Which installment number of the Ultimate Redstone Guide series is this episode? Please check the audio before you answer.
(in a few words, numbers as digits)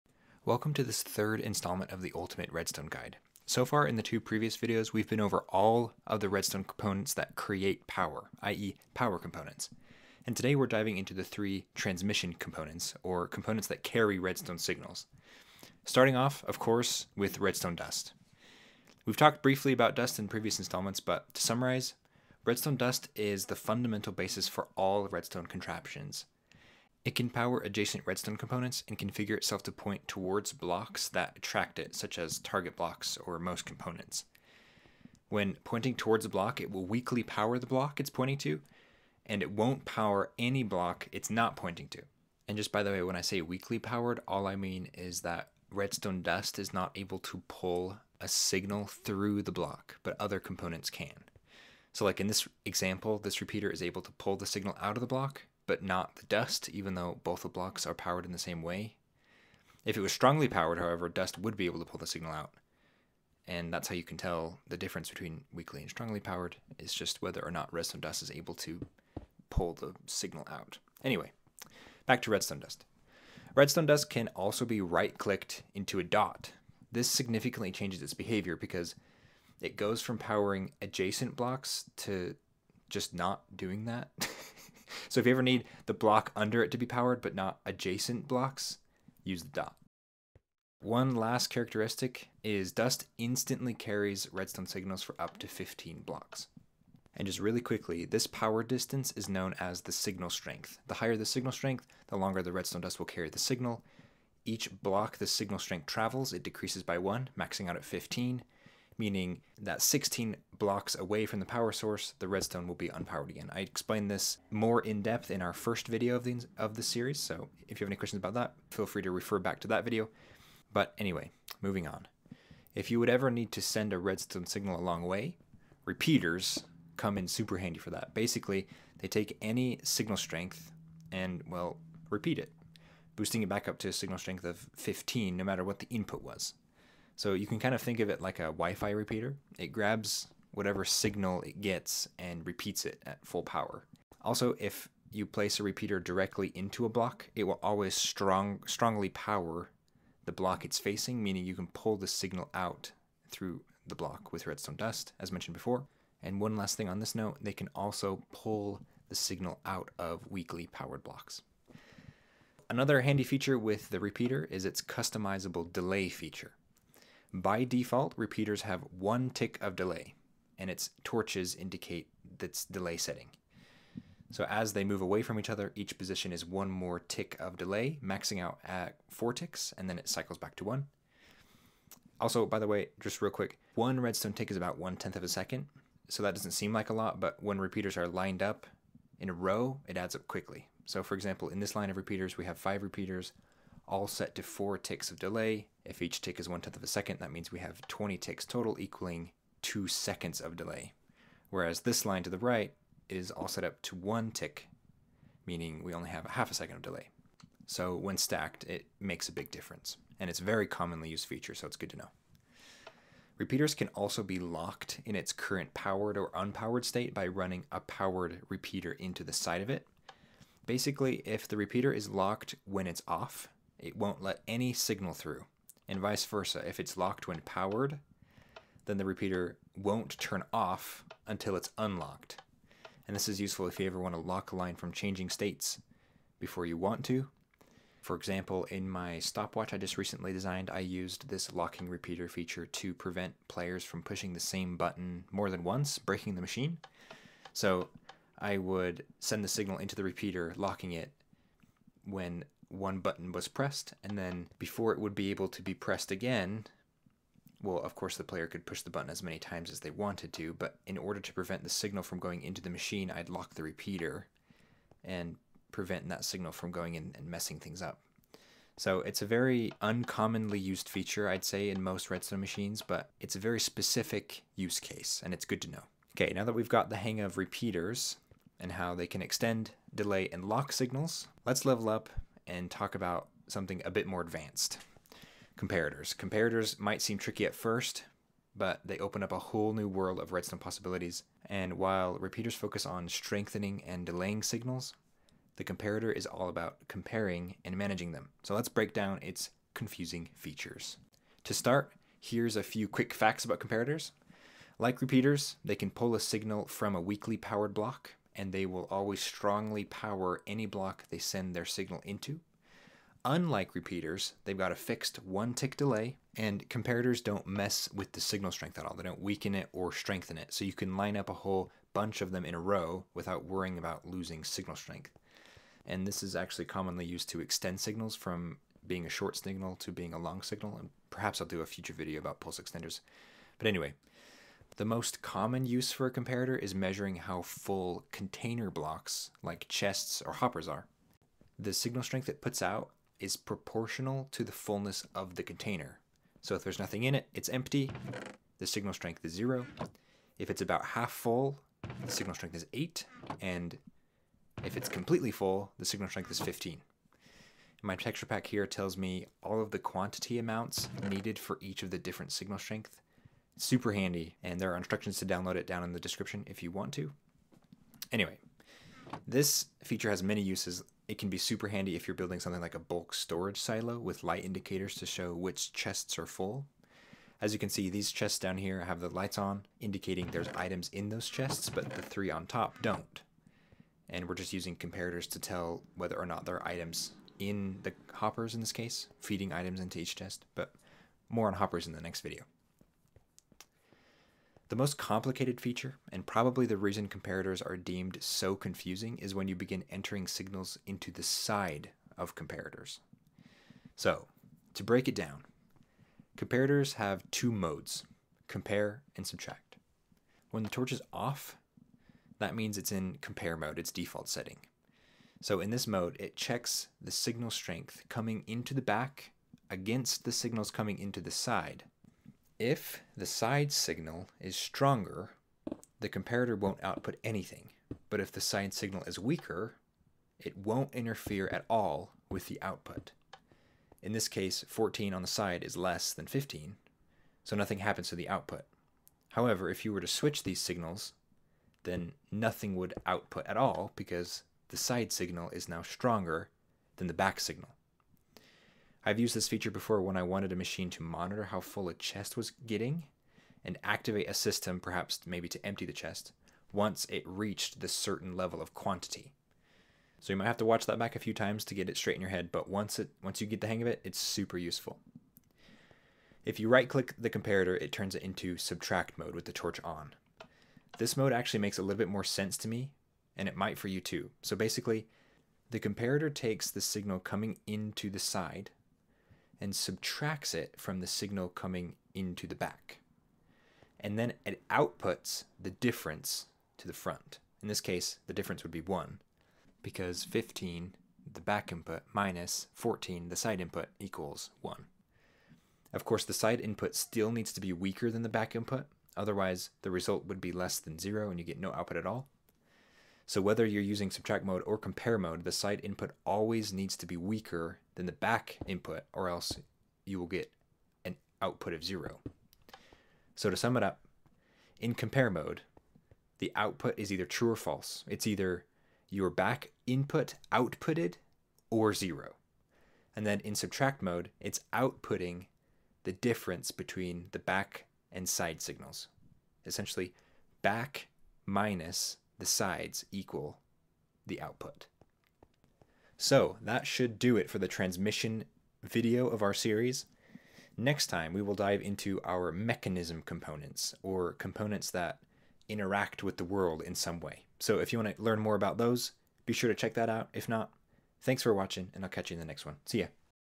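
Third.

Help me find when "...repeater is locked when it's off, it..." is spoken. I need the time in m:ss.
3:41.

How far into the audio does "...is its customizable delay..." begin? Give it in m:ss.
2:44.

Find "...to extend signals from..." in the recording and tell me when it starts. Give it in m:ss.
5:27.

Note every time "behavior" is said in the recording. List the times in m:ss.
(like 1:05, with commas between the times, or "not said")
1:18.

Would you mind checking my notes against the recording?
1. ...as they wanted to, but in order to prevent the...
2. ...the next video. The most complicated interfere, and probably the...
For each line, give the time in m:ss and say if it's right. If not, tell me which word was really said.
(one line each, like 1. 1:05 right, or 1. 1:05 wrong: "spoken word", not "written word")
1. 4:19 right
2. 6:31 wrong: "feature", not "interfere".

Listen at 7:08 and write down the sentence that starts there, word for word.
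But if the side signal is weaker, it won't interfere at all with the output.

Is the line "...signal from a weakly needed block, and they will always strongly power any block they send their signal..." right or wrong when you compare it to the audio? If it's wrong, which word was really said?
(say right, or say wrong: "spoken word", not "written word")
wrong: "powered", not "needed".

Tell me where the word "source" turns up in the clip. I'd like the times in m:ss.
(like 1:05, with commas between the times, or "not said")
1:51.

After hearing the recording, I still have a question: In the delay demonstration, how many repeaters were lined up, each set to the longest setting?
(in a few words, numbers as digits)
5.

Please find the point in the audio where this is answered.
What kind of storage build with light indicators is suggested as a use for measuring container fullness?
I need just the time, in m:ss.
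6:12.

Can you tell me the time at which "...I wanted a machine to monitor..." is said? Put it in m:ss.
7:30.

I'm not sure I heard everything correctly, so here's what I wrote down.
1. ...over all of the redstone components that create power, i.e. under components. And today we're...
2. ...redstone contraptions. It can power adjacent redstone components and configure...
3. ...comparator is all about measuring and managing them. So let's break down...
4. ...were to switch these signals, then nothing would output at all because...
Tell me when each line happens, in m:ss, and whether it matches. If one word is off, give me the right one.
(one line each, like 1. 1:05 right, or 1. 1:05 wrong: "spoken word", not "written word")
1. 0:05 wrong: "power", not "under"
2. 0:25 right
3. 4:55 wrong: "comparing", not "measuring"
4. 7:19 right.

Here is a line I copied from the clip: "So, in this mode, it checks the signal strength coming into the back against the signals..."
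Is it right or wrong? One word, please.
right.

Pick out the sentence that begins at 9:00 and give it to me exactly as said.
Next time, we will dive into our mechanism components, or components that interact with the world in some way.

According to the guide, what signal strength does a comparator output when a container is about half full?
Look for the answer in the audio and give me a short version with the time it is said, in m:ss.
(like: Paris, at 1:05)
8, at 5:52.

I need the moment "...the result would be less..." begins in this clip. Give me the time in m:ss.
8:19.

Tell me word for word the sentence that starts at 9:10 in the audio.
If not, thanks for watching, and I'll catch you in the next one.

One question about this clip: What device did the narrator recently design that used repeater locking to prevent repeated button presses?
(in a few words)
Stopwatch.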